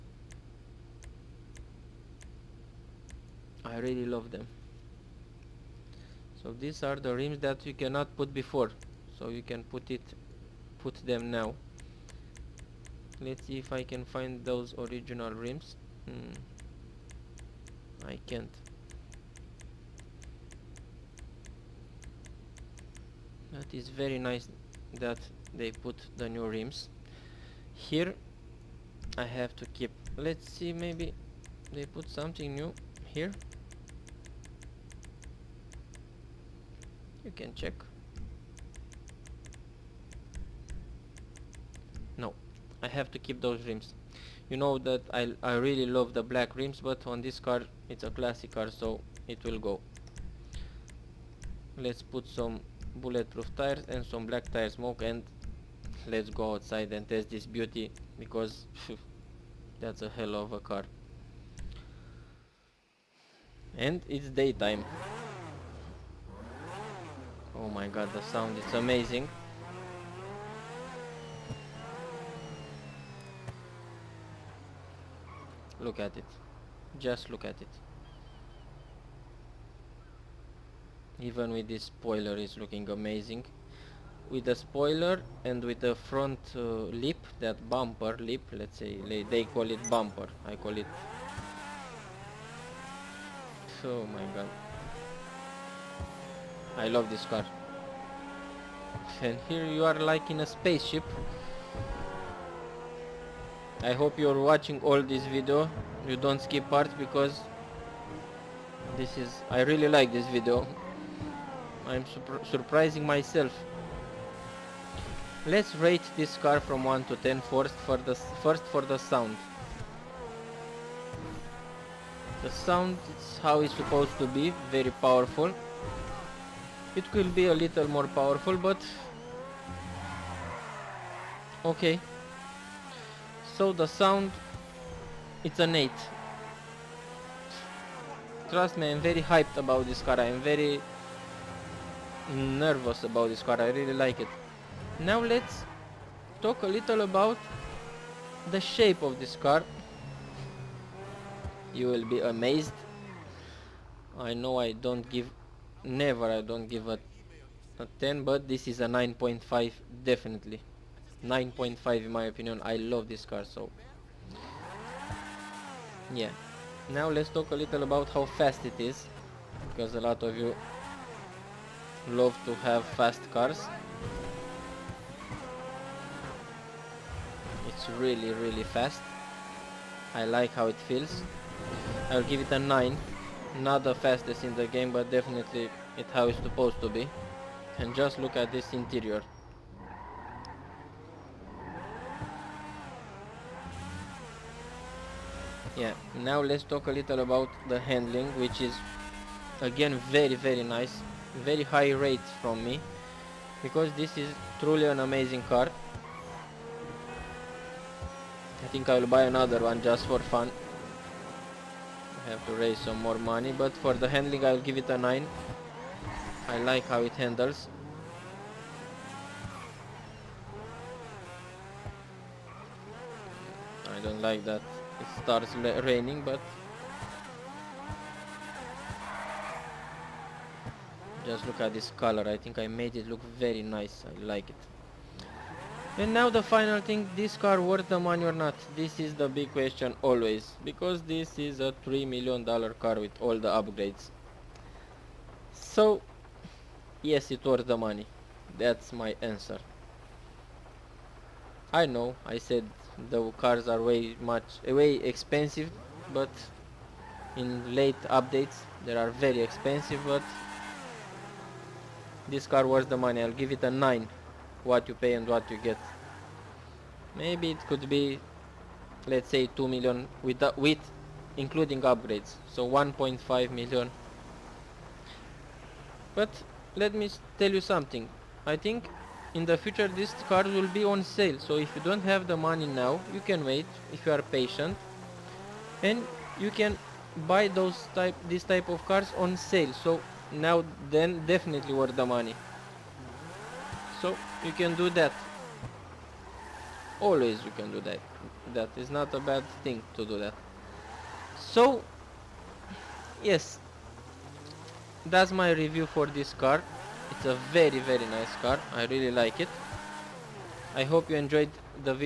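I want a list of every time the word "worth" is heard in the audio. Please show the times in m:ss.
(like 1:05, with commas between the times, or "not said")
3:57, 4:07, 4:22, 4:51.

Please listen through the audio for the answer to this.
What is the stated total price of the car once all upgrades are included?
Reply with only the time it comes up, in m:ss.
4:01.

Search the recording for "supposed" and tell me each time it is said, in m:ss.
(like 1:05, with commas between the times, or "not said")
2:03, 3:06.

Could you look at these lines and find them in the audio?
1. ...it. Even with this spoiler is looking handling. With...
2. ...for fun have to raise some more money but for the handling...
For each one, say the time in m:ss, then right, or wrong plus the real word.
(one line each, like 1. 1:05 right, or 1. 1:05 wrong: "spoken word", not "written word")
1. 1:17 wrong: "amazing", not "handling"
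2. 3:30 right.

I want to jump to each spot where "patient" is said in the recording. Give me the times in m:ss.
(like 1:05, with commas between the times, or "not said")
4:44.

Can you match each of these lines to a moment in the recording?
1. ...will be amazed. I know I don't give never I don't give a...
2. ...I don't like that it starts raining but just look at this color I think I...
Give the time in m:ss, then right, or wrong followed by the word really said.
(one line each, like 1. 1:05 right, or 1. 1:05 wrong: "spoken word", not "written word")
1. 2:31 right
2. 3:43 right.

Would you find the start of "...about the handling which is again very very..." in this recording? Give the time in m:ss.
3:17.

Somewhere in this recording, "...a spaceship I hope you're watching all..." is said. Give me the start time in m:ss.
1:40.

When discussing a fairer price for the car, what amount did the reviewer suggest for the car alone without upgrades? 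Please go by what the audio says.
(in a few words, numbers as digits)
1.5 million.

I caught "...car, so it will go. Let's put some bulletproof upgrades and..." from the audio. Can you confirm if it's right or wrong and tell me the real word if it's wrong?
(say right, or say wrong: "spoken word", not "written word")
wrong: "tires", not "upgrades".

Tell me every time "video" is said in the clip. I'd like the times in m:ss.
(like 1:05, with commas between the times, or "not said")
1:45, 1:50.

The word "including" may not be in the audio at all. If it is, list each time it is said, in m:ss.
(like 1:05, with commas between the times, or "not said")
4:31.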